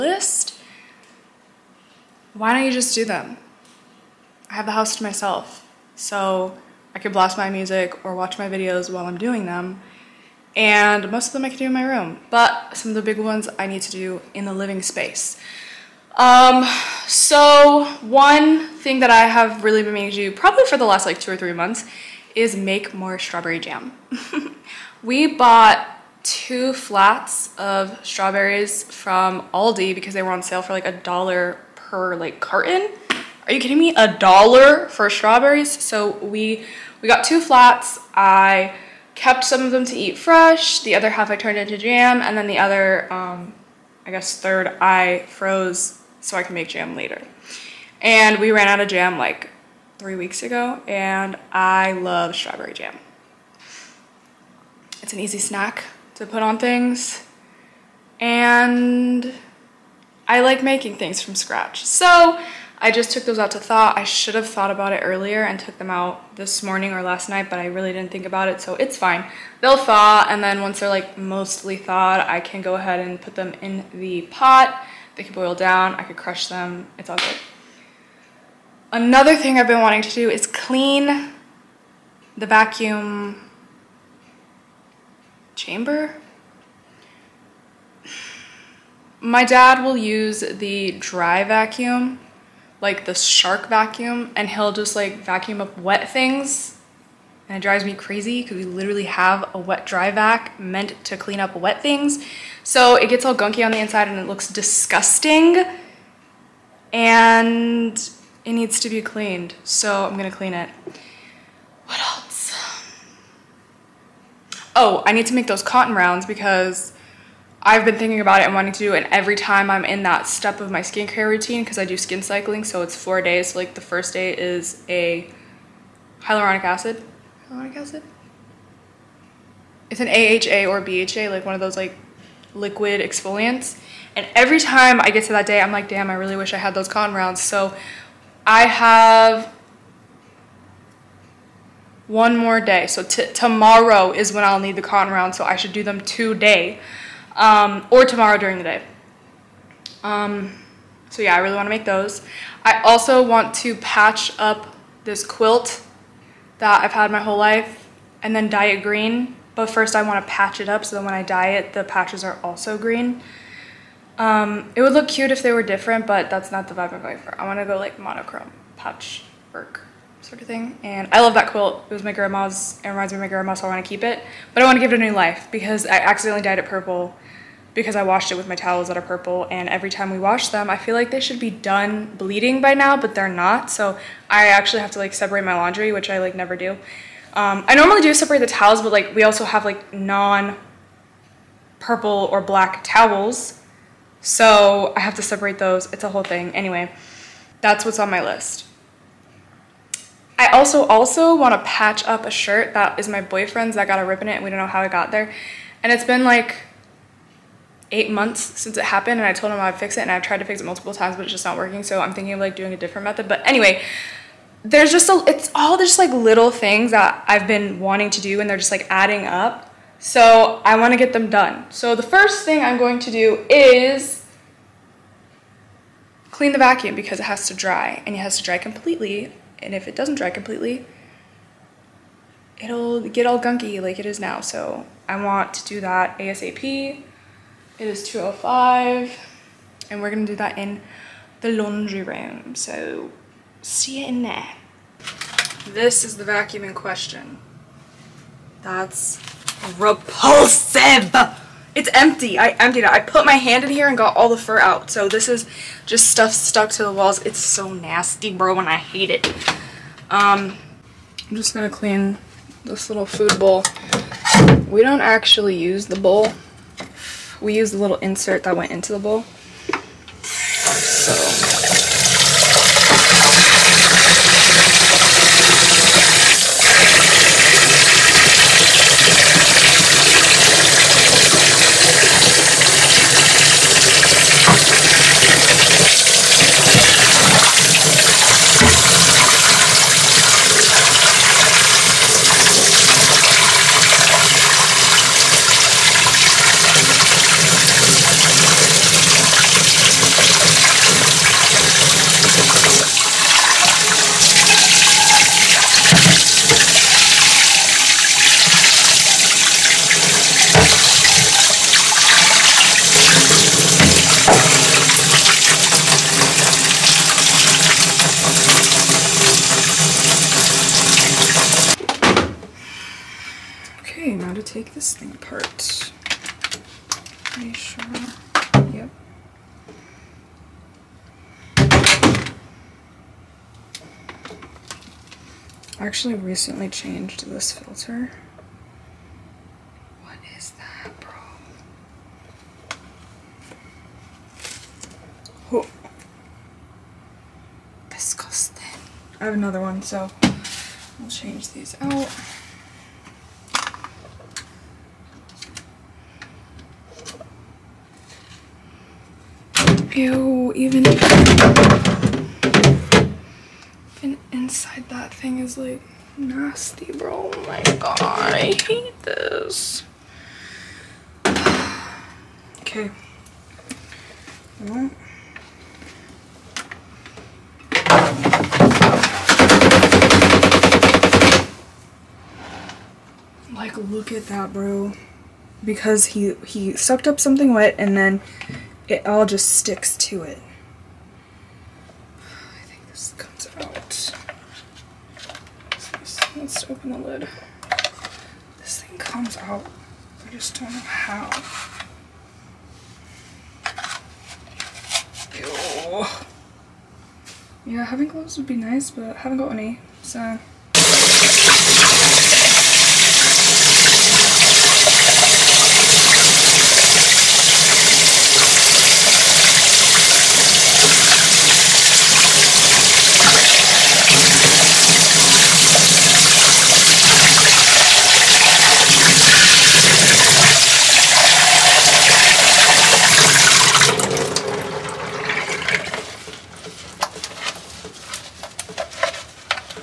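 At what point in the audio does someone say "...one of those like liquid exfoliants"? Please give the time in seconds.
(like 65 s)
131 s.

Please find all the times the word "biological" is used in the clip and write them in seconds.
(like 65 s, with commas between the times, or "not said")
not said.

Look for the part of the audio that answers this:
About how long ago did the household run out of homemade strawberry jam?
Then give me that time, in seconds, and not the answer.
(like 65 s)
50 s.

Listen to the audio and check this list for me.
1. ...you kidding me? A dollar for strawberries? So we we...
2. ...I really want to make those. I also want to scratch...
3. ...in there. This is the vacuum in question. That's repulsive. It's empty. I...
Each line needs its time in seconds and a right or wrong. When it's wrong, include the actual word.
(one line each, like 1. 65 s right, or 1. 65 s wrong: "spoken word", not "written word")
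1. 33 s right
2. 151 s wrong: "patch", not "scratch"
3. 244 s right.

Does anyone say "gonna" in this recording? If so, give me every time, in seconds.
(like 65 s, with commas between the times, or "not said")
110 s, 240 s.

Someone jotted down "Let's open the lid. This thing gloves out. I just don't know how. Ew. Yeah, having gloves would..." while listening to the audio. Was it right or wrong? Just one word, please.
wrong.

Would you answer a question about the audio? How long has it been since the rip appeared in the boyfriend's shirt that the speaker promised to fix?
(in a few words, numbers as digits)
8 months.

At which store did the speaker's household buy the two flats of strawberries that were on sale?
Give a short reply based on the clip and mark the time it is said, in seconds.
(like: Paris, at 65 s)
Aldi, at 29 s.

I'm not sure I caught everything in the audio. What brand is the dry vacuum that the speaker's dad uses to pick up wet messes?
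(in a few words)
Shark.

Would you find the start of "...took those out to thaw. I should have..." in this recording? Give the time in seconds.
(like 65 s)
63 s.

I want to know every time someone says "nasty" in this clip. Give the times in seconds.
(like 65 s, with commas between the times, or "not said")
257 s, 366 s.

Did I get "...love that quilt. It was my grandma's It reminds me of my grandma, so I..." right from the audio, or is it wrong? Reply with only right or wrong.
right.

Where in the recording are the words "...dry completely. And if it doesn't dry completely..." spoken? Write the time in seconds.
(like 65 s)
228 s.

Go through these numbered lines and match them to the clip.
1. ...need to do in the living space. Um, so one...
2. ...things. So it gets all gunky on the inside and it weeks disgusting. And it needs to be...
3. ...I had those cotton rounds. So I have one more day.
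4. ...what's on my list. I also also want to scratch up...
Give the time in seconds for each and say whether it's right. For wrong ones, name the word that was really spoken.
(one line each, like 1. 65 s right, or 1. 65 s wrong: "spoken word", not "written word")
1. 13 s right
2. 101 s wrong: "looks", not "weeks"
3. 136 s right
4. 197 s wrong: "patch", not "scratch".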